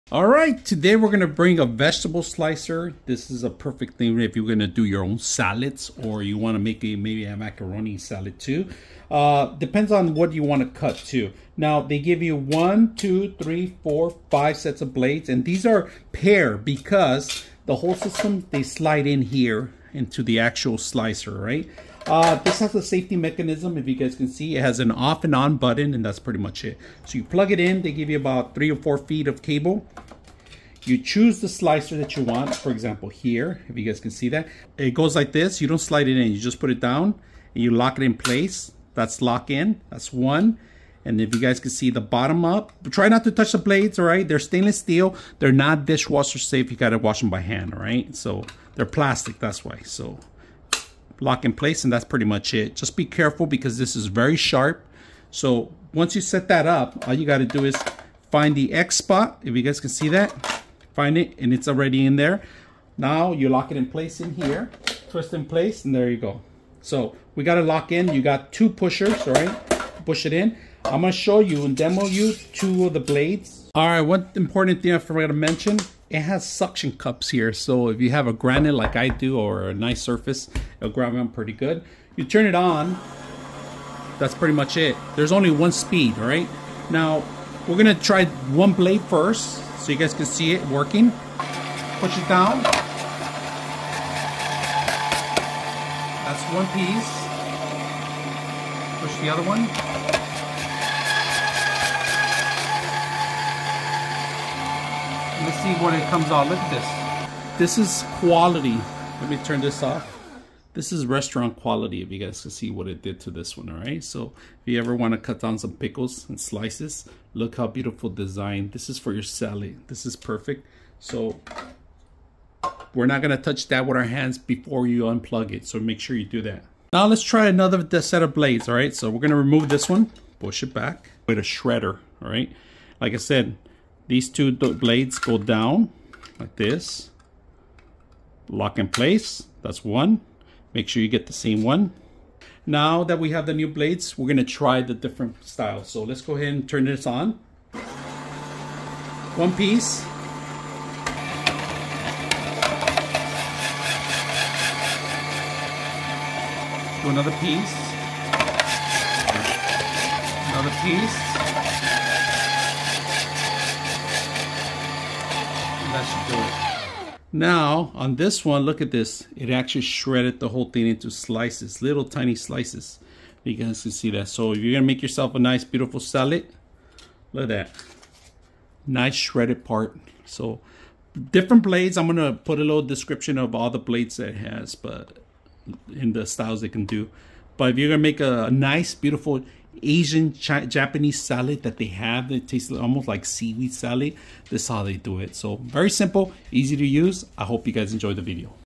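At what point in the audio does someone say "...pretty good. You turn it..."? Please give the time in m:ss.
1:21.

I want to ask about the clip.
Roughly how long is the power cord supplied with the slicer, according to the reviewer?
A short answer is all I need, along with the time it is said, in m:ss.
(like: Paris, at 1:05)
3 or 4 feet, at 0:28.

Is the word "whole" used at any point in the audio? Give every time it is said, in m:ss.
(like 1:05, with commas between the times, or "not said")
0:17, 2:50.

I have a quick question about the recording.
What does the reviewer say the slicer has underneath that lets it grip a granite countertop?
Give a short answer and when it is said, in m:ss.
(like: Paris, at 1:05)
Suction cups, at 1:16.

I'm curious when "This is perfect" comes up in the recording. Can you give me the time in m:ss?
1:59.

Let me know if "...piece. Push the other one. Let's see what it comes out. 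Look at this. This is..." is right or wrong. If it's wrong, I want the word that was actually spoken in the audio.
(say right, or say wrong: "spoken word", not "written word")
right.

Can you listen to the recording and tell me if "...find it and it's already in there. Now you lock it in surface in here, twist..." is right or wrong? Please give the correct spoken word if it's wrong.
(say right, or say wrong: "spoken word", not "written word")
wrong: "place", not "surface".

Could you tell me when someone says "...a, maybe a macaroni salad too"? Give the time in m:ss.
0:06.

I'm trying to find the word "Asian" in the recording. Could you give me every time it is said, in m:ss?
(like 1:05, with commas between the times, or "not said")
3:09.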